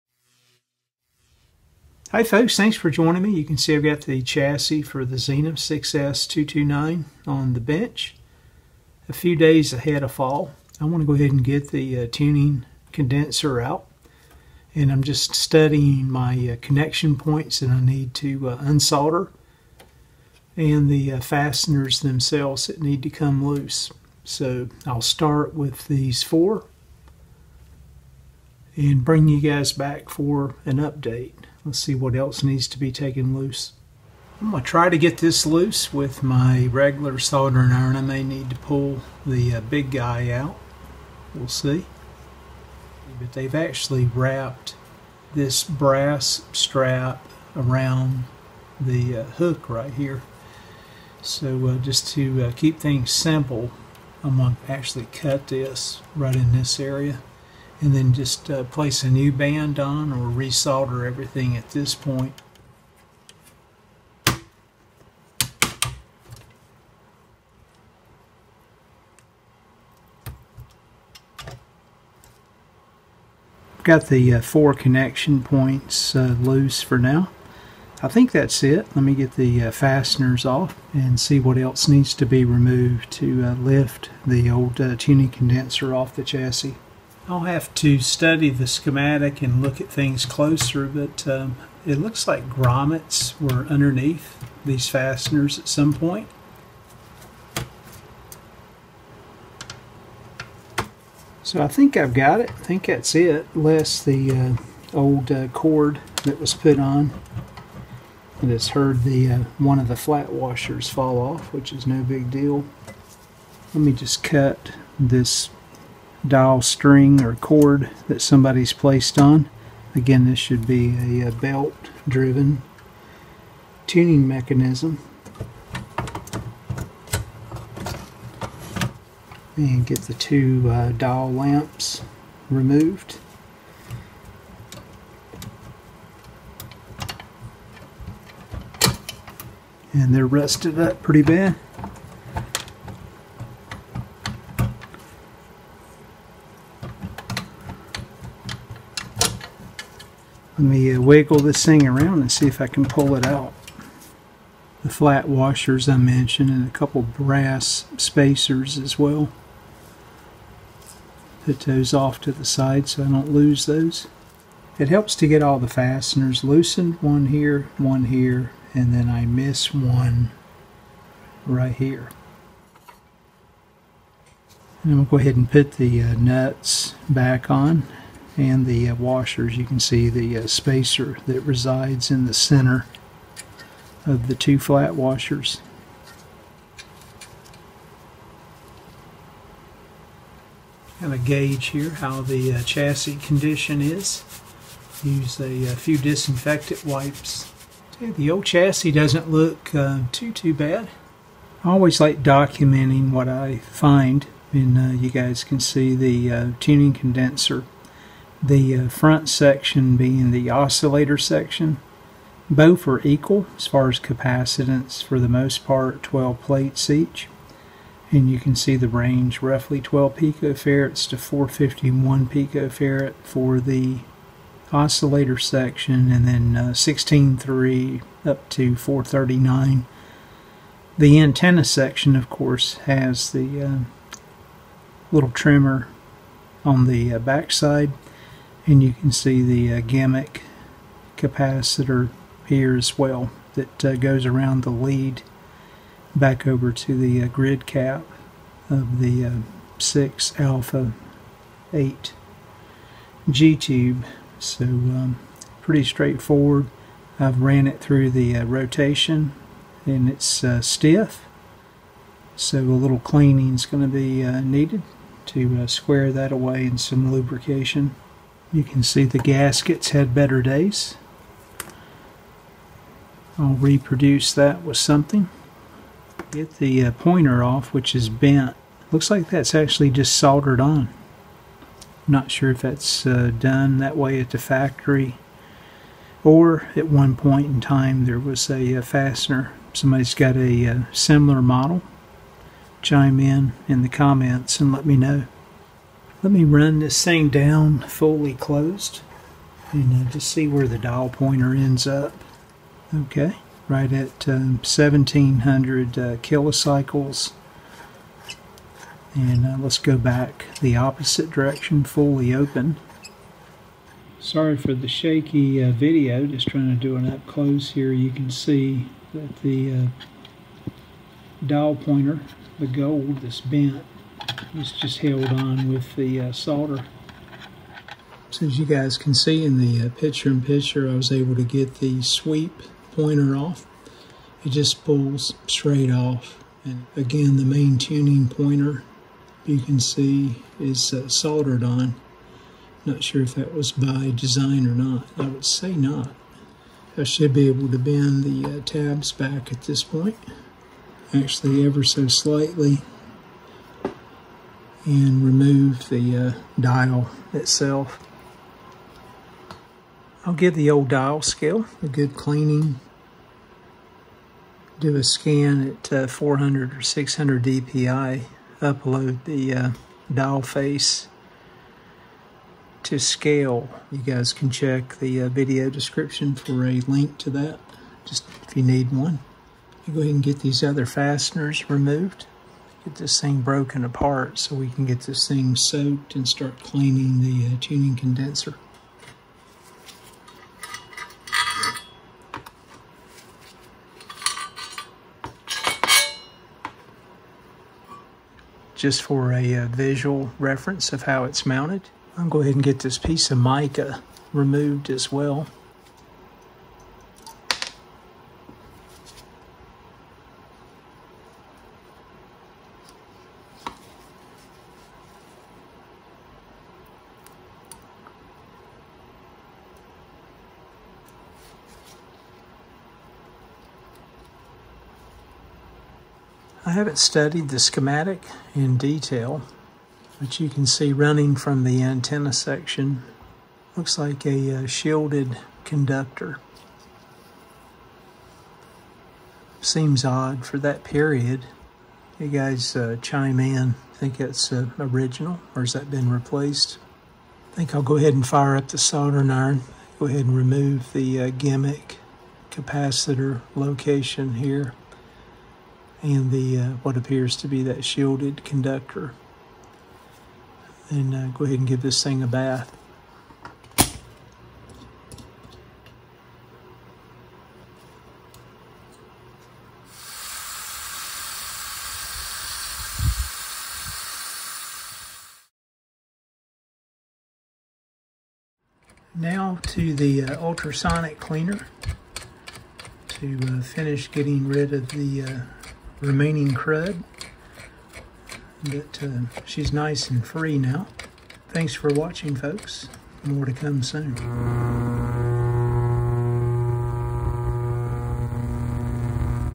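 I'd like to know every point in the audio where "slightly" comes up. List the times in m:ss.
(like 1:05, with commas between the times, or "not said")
5:52.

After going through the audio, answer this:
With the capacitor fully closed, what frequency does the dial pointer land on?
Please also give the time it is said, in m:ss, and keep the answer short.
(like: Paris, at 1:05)
1700 kilocycles, at 5:04.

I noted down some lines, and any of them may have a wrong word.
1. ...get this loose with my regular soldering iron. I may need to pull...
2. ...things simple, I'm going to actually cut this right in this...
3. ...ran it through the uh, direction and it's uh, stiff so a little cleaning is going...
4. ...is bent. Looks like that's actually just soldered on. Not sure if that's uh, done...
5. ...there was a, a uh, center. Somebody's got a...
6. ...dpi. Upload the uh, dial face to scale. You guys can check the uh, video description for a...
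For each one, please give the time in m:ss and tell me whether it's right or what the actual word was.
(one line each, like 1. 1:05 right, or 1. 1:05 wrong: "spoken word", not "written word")
1. 0:34 right
2. 0:52 right
3. 4:17 wrong: "rotation", not "direction"
4. 4:37 right
5. 4:48 wrong: "fastener", not "center"
6. 6:07 right.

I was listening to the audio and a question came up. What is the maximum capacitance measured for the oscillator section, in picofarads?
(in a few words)
451.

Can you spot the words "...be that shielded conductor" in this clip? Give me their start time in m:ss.
7:37.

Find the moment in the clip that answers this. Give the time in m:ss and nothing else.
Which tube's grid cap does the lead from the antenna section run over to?
4:09.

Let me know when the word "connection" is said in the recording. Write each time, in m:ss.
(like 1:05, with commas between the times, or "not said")
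0:16, 1:14.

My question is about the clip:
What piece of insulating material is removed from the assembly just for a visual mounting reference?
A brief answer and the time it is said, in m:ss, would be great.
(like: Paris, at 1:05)
mica, at 6:43.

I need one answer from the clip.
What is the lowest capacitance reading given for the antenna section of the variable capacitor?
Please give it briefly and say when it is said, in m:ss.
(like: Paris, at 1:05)
16.3, at 3:46.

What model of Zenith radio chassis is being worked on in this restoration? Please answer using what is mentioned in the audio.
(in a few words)
6S229.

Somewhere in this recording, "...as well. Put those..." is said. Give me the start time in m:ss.
2:38.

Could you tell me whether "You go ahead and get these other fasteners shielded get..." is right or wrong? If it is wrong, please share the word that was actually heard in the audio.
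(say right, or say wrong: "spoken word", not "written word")
wrong: "removed", not "shielded".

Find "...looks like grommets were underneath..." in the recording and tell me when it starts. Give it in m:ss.
1:31.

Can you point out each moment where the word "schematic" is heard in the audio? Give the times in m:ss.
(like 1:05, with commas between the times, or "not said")
1:28, 7:07.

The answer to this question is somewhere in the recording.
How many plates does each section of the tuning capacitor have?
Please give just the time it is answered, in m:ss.
3:36.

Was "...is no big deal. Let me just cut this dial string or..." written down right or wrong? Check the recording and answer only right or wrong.
right.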